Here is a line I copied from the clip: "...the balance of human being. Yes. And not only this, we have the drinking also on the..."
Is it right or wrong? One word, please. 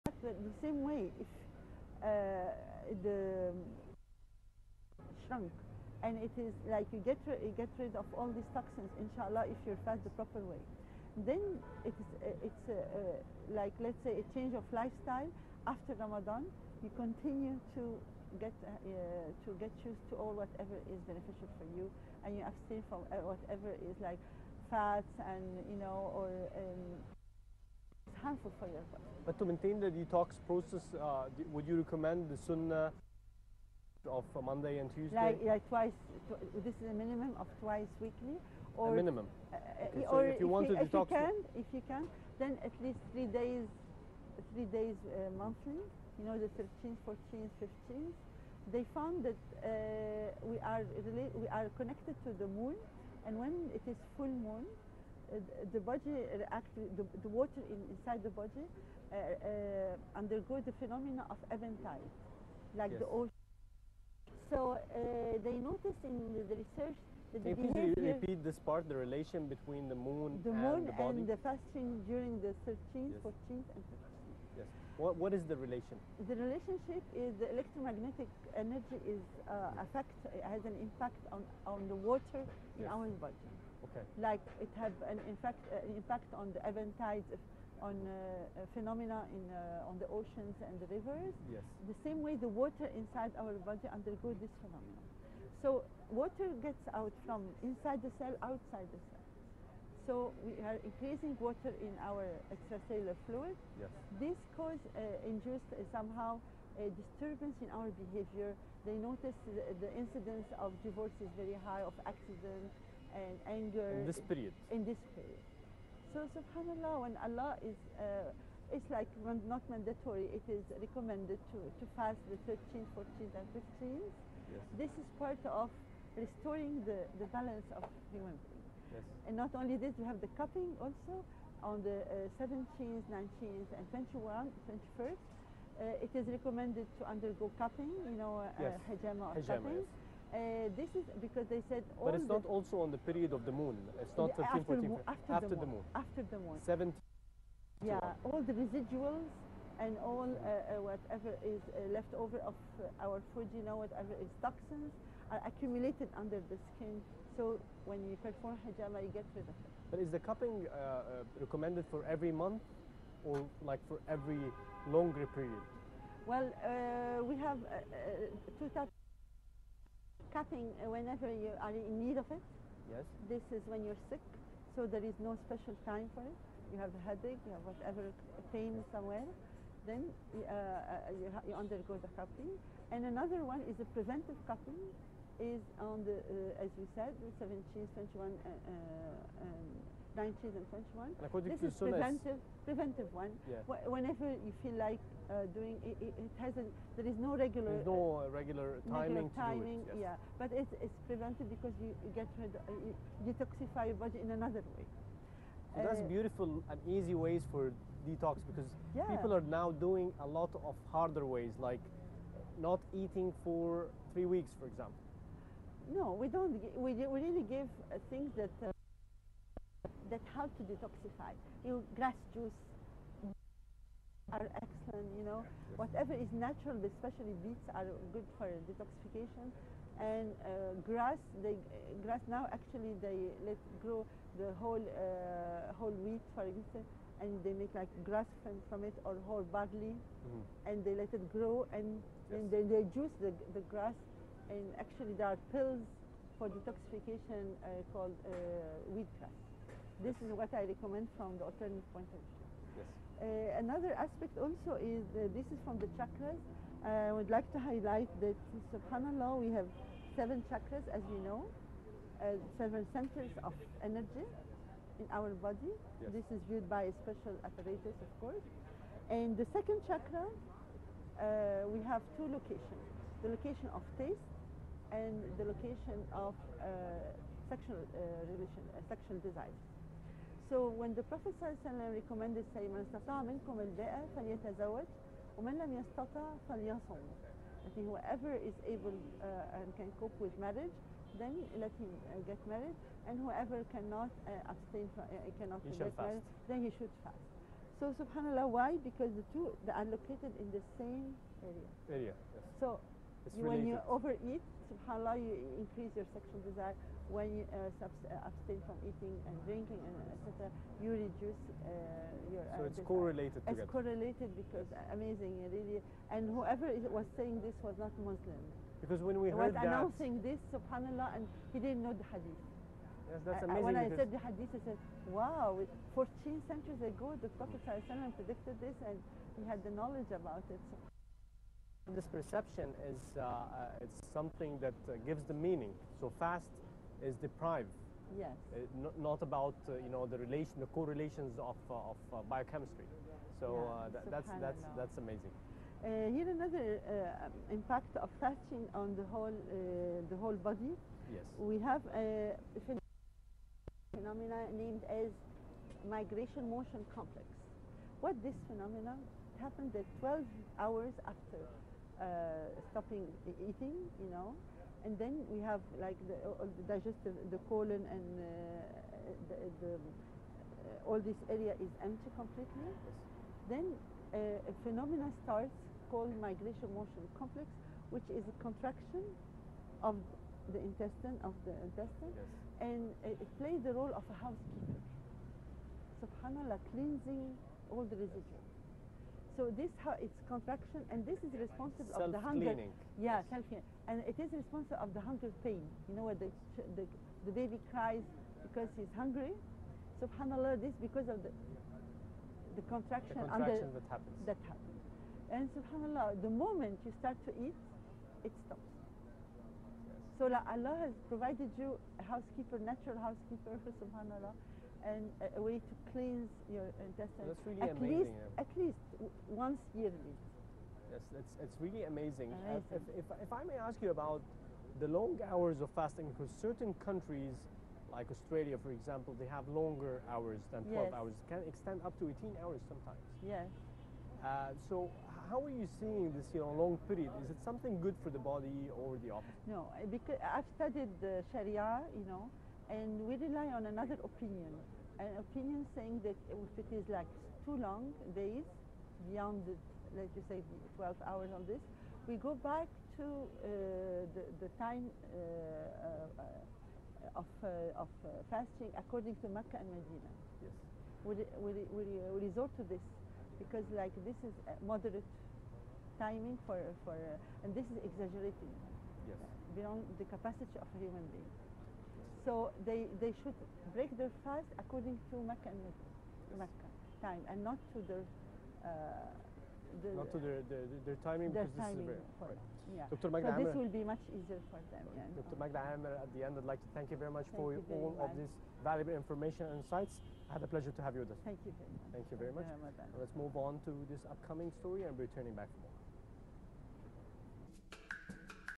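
wrong.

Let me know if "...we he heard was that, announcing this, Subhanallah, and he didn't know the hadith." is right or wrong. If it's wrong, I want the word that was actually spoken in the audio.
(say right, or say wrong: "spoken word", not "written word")
right.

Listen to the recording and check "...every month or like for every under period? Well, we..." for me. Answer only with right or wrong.
wrong.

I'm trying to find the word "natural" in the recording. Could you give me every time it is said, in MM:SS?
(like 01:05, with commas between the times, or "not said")
03:46, 06:52.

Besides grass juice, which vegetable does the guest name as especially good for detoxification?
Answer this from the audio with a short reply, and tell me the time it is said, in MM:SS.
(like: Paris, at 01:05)
beets, at 03:47.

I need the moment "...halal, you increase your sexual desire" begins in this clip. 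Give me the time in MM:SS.
05:04.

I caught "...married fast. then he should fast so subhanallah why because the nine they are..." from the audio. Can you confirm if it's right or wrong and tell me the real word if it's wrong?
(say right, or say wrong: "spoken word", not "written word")
wrong: "two", not "nine".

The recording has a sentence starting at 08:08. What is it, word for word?
of this valuable information and insights.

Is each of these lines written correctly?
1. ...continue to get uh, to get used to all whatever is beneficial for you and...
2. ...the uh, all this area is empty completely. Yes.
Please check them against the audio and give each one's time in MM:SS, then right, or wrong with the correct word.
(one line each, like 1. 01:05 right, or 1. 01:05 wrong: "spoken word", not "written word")
1. 00:16 right
2. 06:09 right.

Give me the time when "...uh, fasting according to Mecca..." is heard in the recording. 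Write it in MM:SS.
07:38.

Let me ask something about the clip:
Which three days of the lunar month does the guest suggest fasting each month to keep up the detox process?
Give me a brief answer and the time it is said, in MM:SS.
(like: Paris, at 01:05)
13th, 14th, 15th, at 00:46.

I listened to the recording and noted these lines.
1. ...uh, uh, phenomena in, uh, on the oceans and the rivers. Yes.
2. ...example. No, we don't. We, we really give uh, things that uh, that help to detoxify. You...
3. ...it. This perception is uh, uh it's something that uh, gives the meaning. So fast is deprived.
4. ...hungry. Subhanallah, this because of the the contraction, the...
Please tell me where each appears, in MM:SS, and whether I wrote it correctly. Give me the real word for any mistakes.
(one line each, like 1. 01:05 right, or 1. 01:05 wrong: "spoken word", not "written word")
1. 01:27 right
2. 03:34 right
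3. 05:30 right
4. 06:38 right.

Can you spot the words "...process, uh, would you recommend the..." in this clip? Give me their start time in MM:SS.
00:30.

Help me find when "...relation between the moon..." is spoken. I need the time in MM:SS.
01:08.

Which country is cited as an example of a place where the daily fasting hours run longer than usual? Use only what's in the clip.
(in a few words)
Australia.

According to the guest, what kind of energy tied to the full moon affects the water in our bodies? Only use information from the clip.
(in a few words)
electromagnetic energy.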